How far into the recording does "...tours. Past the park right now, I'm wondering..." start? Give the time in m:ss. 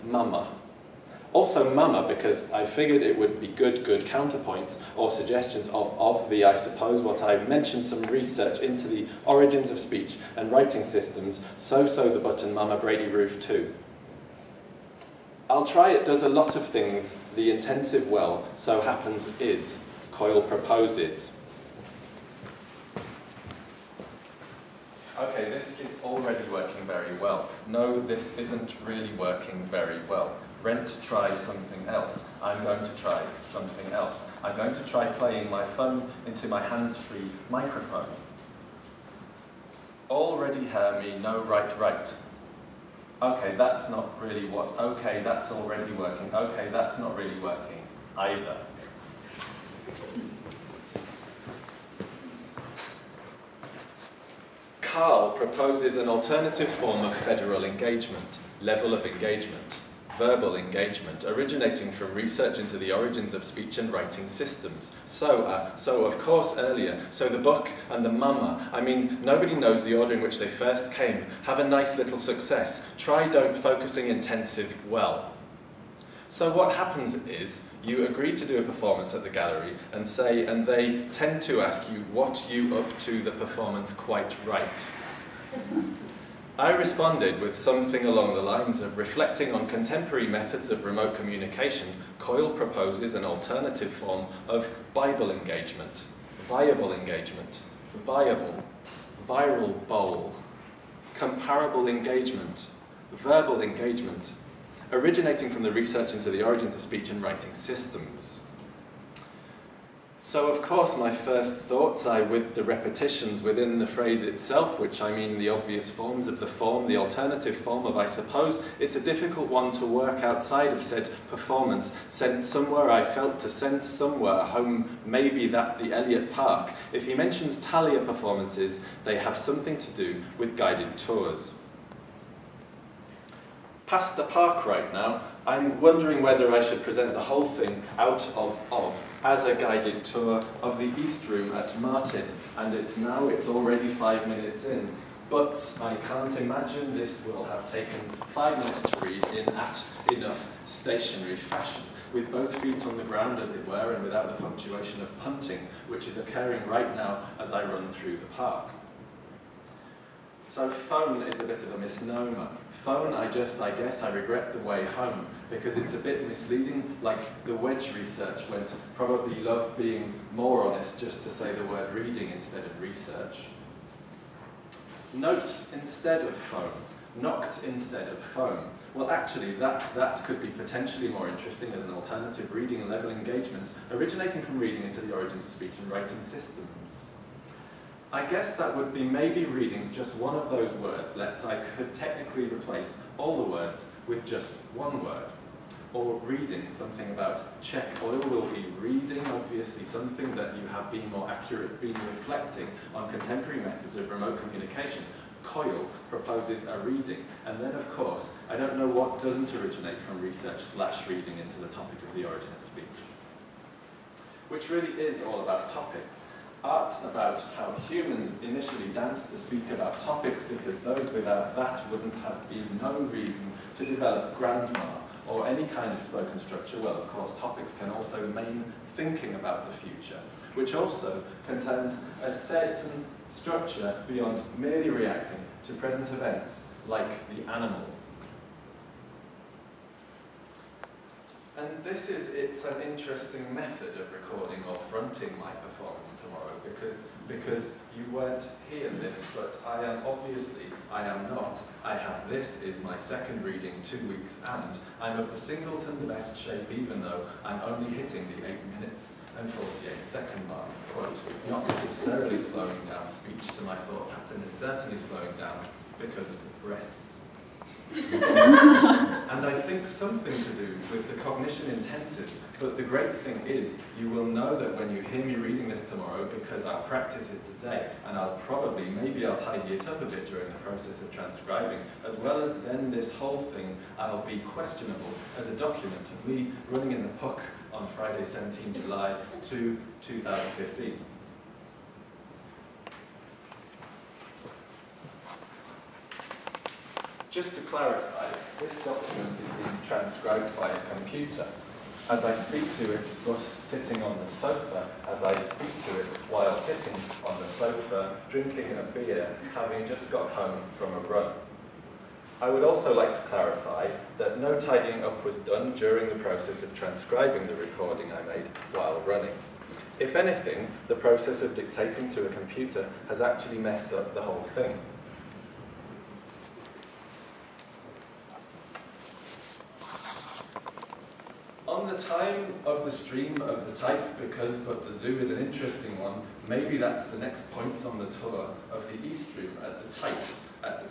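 2:10.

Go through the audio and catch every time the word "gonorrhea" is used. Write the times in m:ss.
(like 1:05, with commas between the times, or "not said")
not said.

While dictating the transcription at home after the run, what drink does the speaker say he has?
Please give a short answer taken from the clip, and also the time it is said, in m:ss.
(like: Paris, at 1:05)
beer, at 5:08.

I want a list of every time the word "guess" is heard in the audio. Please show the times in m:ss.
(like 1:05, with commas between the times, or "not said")
2:43, 3:08.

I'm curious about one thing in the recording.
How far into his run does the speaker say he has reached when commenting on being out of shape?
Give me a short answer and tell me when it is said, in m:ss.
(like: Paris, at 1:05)
8 minutes 48 seconds, at 4:18.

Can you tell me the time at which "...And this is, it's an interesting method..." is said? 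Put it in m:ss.
4:01.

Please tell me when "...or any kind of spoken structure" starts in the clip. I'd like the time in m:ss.
3:45.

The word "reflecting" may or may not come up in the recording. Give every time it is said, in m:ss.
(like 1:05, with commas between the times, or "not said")
1:28, 3:21.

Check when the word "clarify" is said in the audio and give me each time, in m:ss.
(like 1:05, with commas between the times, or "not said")
4:57, 5:13.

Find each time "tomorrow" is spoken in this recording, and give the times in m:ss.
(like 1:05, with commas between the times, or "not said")
4:06, 4:35.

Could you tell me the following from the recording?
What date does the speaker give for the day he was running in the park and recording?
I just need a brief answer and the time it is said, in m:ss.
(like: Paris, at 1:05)
17 July 2015, at 4:47.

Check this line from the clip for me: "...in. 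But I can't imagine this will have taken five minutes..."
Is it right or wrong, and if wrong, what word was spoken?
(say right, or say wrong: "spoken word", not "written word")
right.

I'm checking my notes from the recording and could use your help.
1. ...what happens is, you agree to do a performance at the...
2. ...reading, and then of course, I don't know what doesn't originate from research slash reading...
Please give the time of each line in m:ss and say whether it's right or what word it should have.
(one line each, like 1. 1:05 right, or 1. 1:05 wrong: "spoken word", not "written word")
1. 1:16 right
2. 3:26 right.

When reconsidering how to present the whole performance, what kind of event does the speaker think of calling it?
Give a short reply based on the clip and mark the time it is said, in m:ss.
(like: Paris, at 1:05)
guided tour, at 2:19.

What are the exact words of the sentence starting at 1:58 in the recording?
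It's a difficult one to work outside of said performance.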